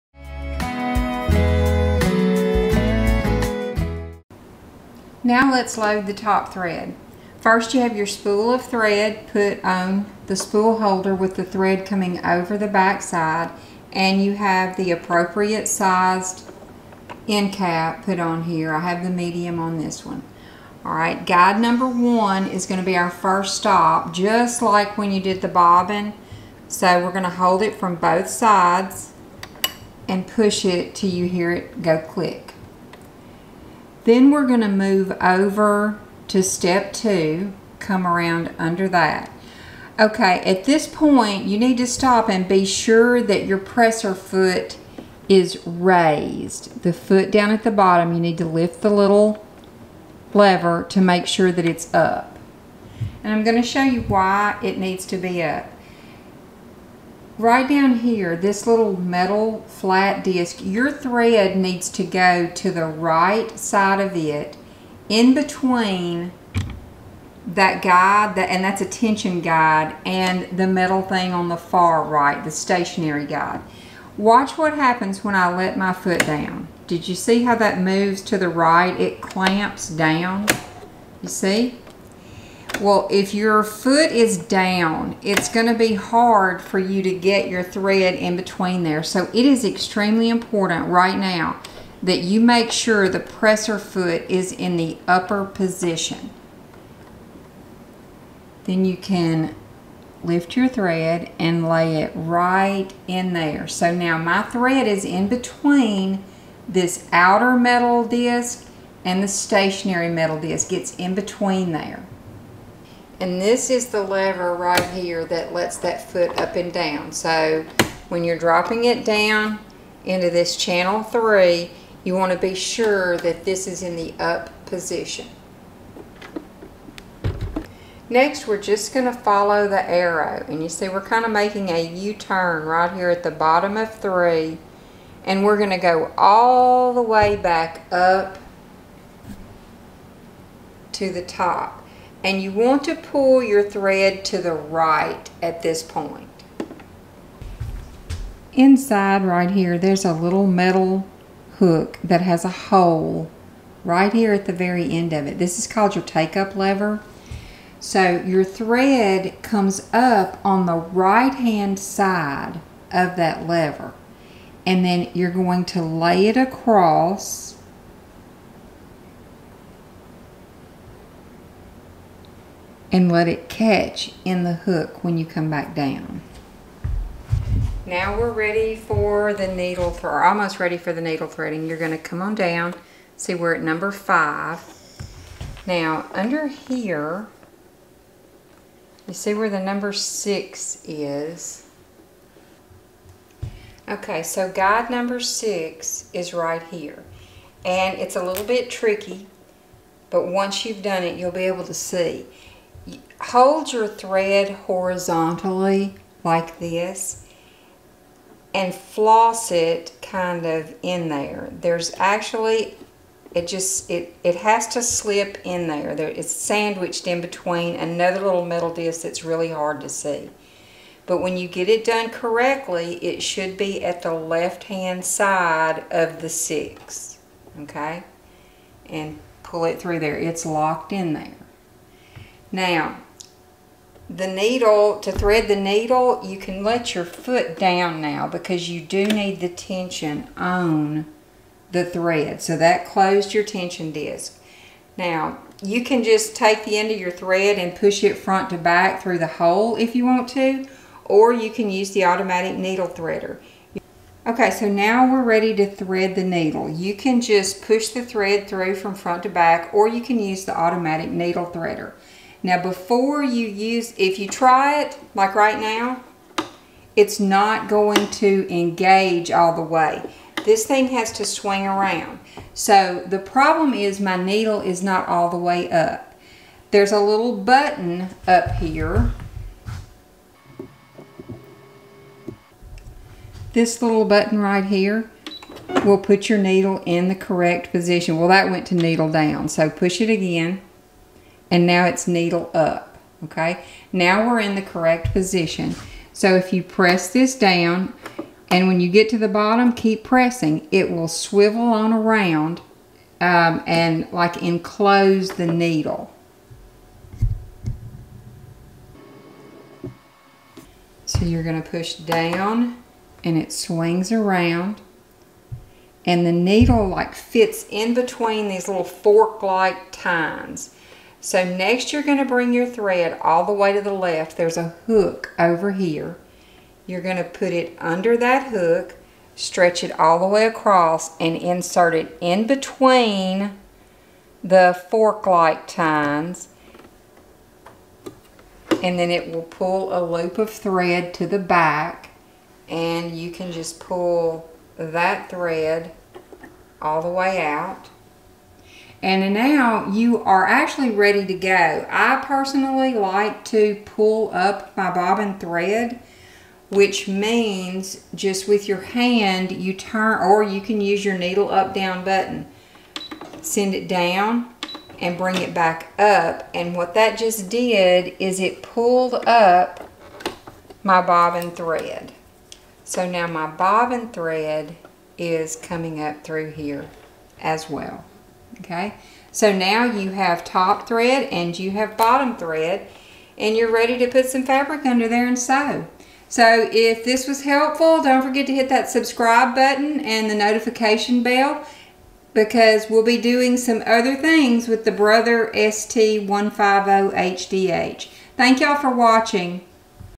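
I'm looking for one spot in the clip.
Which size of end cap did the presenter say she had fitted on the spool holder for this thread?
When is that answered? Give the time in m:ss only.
0:19.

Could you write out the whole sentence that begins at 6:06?
And what that just did is it pulled up my bobbin thread.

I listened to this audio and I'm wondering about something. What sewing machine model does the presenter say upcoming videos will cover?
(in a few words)
Brother ST150HDH.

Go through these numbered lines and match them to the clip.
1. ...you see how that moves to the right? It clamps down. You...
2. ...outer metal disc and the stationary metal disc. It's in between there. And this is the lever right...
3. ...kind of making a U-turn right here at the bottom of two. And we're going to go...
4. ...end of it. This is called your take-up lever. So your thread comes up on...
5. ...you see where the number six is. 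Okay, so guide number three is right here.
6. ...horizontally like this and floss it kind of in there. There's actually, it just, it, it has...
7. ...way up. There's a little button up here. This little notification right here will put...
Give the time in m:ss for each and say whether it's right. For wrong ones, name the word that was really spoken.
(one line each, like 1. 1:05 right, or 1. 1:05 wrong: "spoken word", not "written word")
1. 1:17 right
2. 1:47 right
3. 2:10 wrong: "three", not "two"
4. 2:34 right
5. 3:09 wrong: "six", not "three"
6. 3:24 right
7. 4:35 wrong: "button", not "notification".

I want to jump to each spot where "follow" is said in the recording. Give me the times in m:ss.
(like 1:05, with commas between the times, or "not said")
2:09.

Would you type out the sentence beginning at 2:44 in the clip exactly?
And then you're going to lay it across and let it catch in the hook when you come back down.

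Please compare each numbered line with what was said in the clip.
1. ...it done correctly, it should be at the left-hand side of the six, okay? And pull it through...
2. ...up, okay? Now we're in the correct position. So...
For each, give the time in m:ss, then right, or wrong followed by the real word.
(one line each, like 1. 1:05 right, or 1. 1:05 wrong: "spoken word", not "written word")
1. 3:41 right
2. 4:52 right.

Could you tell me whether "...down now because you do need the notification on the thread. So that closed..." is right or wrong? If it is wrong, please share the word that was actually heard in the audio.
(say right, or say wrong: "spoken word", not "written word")
wrong: "tension", not "notification".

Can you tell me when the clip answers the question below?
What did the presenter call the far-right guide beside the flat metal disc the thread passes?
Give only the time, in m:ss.
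1:12.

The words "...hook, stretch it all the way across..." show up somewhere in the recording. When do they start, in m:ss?
5:28.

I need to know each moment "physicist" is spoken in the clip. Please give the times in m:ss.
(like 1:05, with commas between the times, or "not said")
not said.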